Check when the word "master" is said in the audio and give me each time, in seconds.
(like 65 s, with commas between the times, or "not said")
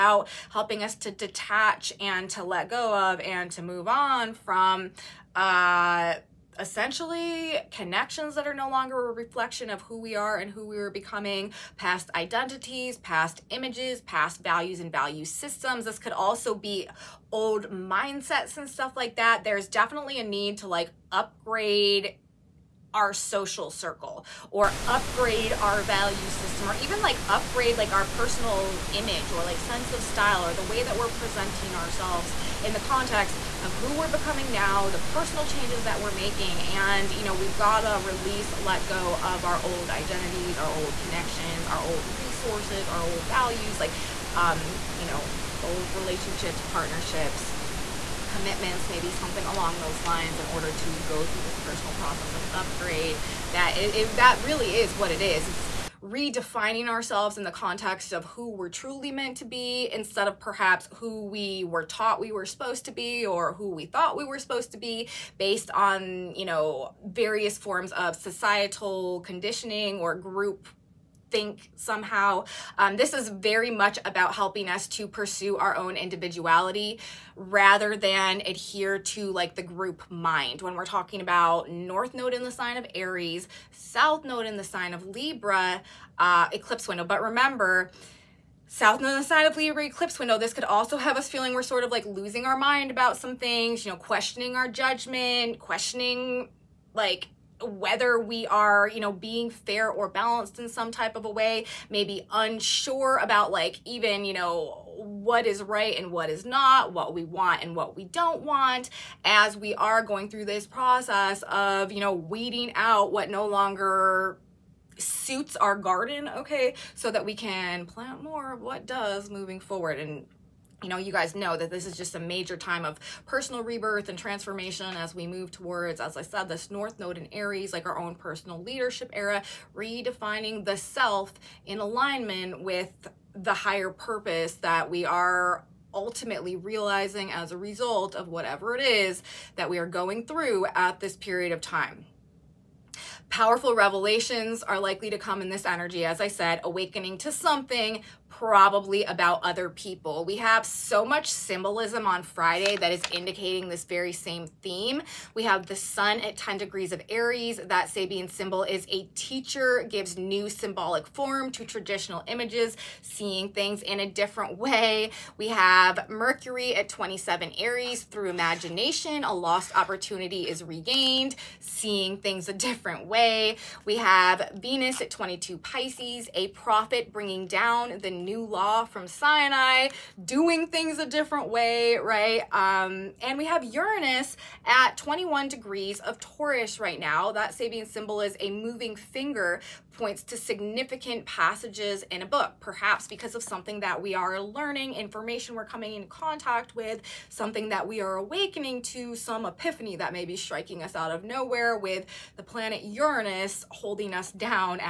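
not said.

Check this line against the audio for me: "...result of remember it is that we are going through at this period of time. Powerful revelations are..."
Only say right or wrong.
wrong.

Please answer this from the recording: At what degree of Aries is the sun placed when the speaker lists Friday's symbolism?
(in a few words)
10.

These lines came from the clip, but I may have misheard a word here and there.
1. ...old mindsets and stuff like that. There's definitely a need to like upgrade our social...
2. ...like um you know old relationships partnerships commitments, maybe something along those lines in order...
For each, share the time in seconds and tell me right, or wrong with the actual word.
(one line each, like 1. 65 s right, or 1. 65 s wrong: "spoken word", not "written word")
1. 17 s right
2. 43 s right.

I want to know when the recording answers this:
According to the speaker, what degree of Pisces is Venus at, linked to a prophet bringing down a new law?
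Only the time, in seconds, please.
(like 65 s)
175 s.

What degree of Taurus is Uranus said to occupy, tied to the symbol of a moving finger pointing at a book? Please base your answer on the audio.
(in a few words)
21.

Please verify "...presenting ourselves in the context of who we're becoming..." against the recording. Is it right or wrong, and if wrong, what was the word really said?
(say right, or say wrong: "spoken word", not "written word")
right.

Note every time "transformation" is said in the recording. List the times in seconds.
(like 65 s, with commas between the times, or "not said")
124 s.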